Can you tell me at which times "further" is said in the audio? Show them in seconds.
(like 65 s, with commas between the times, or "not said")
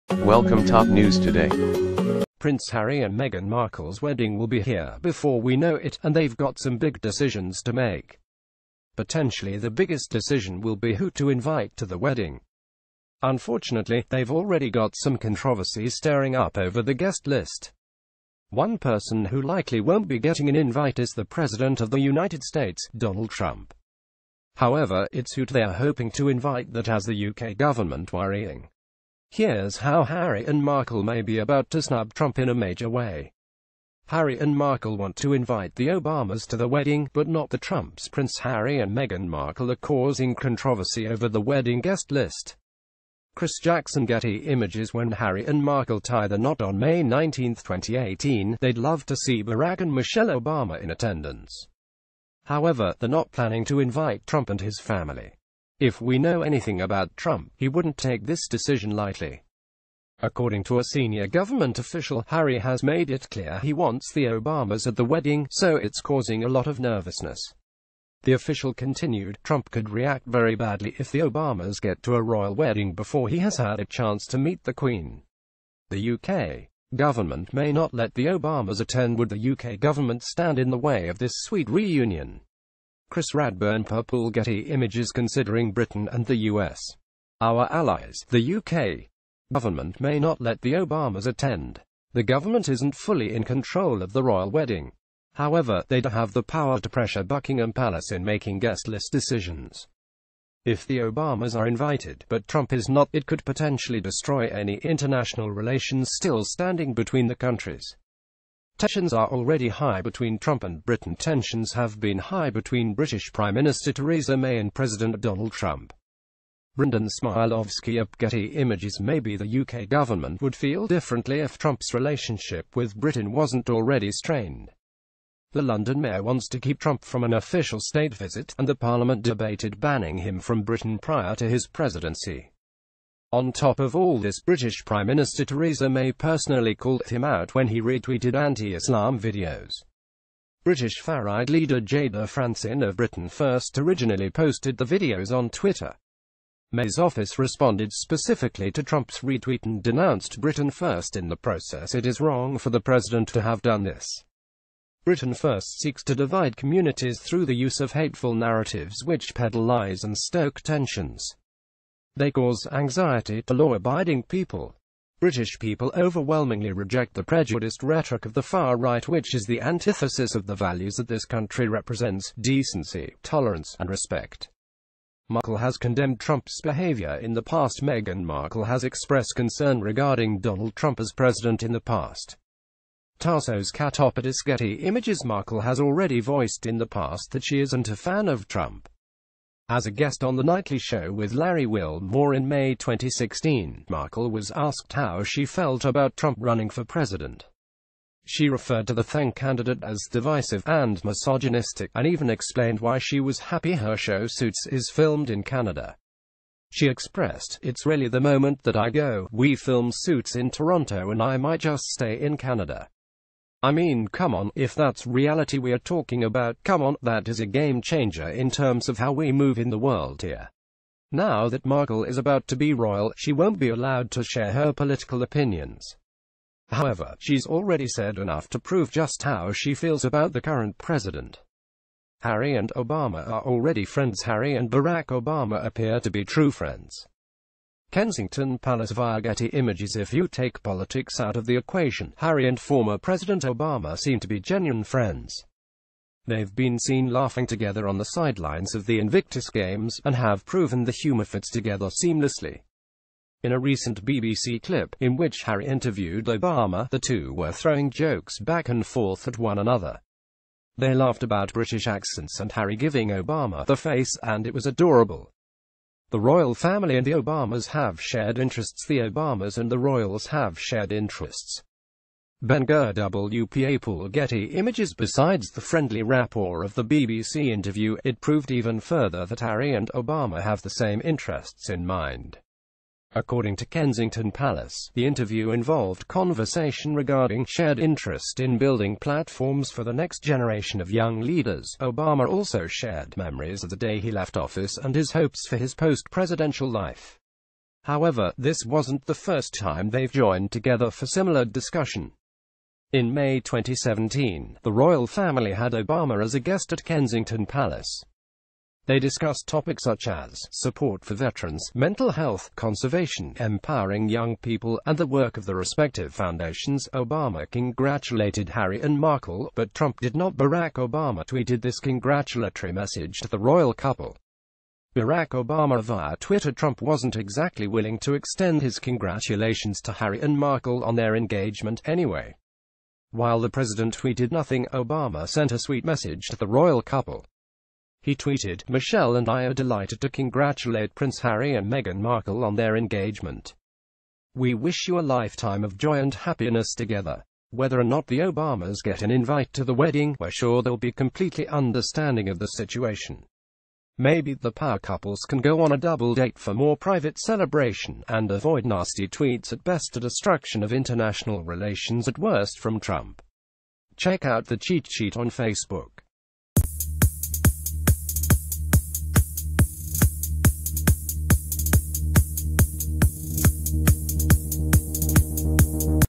278 s.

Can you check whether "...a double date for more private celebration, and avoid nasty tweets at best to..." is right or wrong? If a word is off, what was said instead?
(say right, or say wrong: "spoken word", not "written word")
right.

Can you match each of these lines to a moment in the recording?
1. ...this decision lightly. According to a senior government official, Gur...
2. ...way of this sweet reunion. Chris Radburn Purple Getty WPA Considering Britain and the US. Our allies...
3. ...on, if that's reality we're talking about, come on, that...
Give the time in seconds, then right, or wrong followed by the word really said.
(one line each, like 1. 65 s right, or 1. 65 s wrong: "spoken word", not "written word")
1. 58 s wrong: "Harry", not "Gur"
2. 80 s wrong: "Images", not "WPA"
3. 214 s right.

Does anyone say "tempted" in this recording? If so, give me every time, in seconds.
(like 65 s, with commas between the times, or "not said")
not said.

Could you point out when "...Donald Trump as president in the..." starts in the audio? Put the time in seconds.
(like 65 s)
180 s.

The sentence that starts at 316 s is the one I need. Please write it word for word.
Obama congratulated Harry and Markle, but Trump did not.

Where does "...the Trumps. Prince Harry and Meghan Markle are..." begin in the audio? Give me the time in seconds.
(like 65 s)
37 s.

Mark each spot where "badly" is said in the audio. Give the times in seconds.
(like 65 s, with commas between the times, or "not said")
70 s.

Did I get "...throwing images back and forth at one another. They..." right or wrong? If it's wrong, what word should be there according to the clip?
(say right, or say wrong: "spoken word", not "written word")
wrong: "jokes", not "images".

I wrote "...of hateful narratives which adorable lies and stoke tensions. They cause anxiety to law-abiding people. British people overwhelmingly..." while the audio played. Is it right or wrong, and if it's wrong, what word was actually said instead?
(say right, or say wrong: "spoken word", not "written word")
wrong: "peddle", not "adorable".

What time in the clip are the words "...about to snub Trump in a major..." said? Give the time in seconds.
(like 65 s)
31 s.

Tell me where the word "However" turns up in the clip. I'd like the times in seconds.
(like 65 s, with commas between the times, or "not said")
24 s, 52 s, 95 s, 226 s, 297 s.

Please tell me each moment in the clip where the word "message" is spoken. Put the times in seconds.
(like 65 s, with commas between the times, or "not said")
322 s, 335 s.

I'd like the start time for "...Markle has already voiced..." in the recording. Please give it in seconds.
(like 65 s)
185 s.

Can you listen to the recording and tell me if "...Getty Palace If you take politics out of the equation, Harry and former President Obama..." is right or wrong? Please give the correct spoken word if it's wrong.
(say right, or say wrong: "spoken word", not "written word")
wrong: "Images", not "Palace".